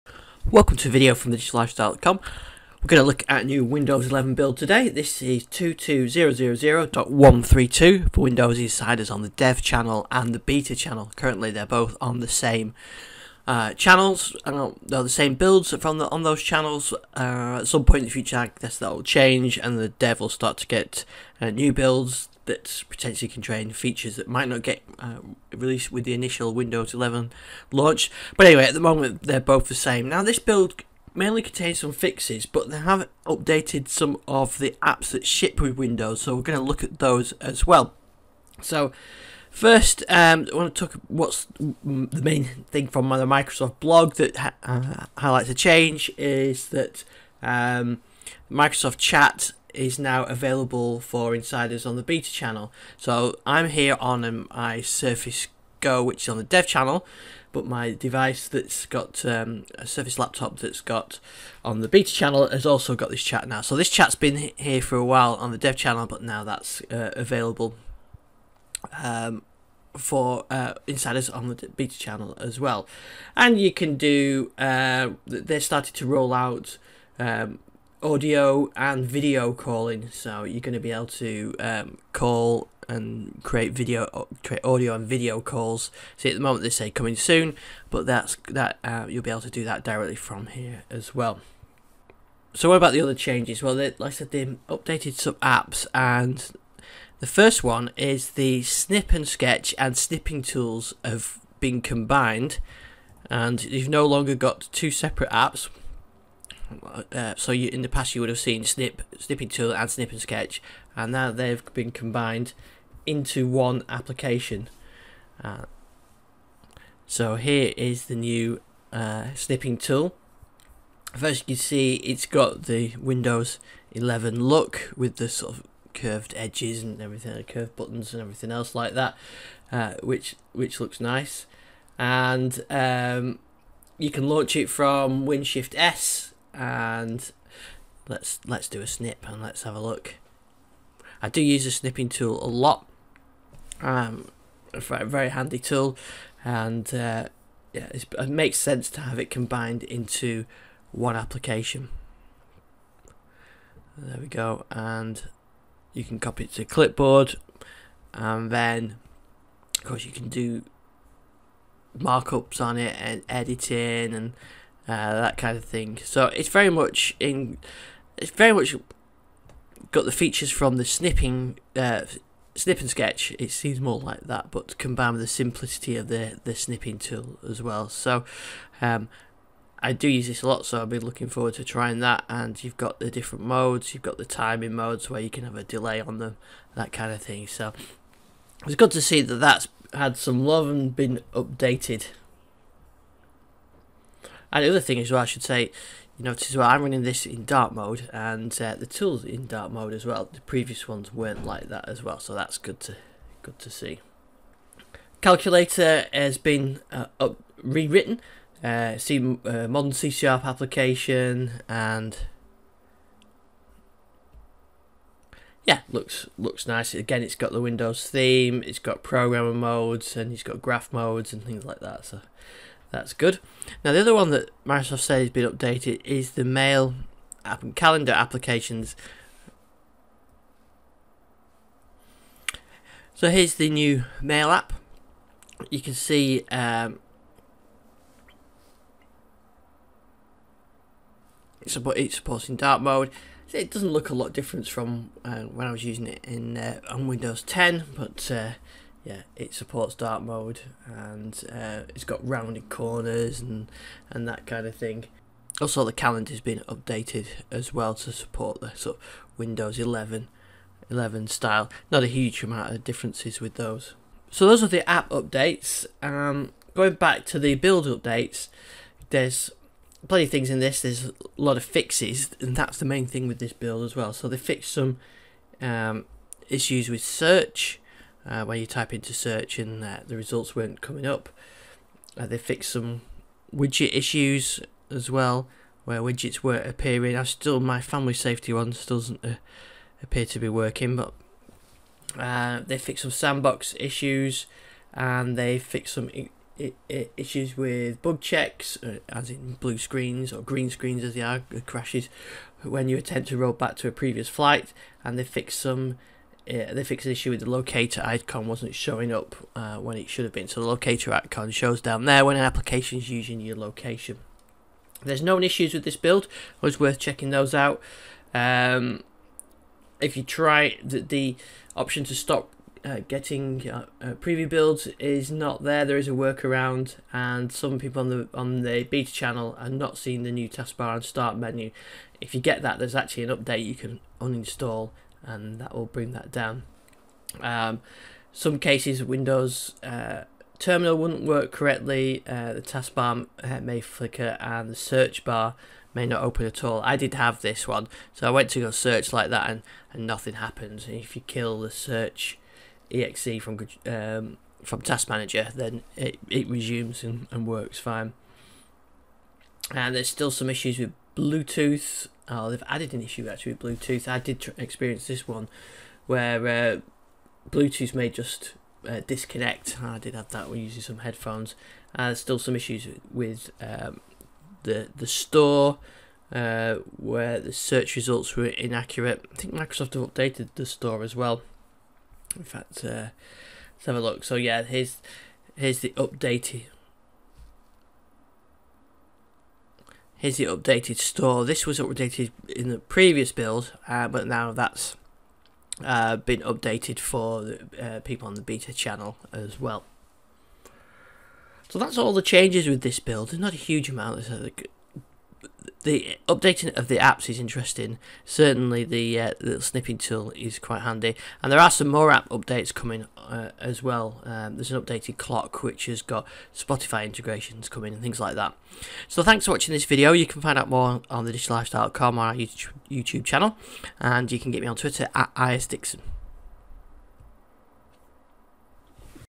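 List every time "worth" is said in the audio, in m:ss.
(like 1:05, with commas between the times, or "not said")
5:16.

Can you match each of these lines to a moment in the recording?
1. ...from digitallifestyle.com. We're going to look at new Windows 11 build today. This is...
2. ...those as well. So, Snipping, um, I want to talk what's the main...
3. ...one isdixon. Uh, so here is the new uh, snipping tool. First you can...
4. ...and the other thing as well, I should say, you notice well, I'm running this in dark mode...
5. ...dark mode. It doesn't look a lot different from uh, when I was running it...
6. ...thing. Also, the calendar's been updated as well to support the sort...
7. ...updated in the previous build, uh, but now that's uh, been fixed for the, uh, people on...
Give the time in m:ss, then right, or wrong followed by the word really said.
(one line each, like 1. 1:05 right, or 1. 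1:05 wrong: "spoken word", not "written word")
1. 0:01 right
2. 0:36 wrong: "First", not "Snipping"
3. 1:53 wrong: "application", not "isdixon"
4. 3:14 right
5. 4:02 wrong: "using", not "running"
6. 4:14 right
7. 6:31 wrong: "updated", not "fixed".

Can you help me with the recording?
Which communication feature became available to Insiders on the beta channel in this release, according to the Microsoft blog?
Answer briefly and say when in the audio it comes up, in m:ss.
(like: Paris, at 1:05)
Microsoft Chat, at 0:48.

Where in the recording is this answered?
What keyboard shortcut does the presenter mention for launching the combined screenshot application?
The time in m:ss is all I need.
2:15.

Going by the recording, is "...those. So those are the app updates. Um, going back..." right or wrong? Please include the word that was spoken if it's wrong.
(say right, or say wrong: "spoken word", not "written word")
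right.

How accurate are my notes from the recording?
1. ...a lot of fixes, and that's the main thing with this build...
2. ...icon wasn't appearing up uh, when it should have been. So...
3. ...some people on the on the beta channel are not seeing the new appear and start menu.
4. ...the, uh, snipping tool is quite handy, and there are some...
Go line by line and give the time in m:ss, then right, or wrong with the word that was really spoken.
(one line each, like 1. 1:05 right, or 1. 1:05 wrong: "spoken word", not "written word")
1. 4:31 right
2. 5:08 wrong: "showing", not "appearing"
3. 5:27 wrong: "taskbar", not "appear"
4. 6:48 right.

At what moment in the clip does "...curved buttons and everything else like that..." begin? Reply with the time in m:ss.
2:07.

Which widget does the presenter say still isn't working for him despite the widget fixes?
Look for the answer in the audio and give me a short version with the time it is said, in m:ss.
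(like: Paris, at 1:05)
Family Safety, at 4:47.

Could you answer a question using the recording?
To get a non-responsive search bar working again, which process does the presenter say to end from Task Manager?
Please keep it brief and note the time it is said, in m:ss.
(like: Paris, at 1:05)
search exe, at 5:51.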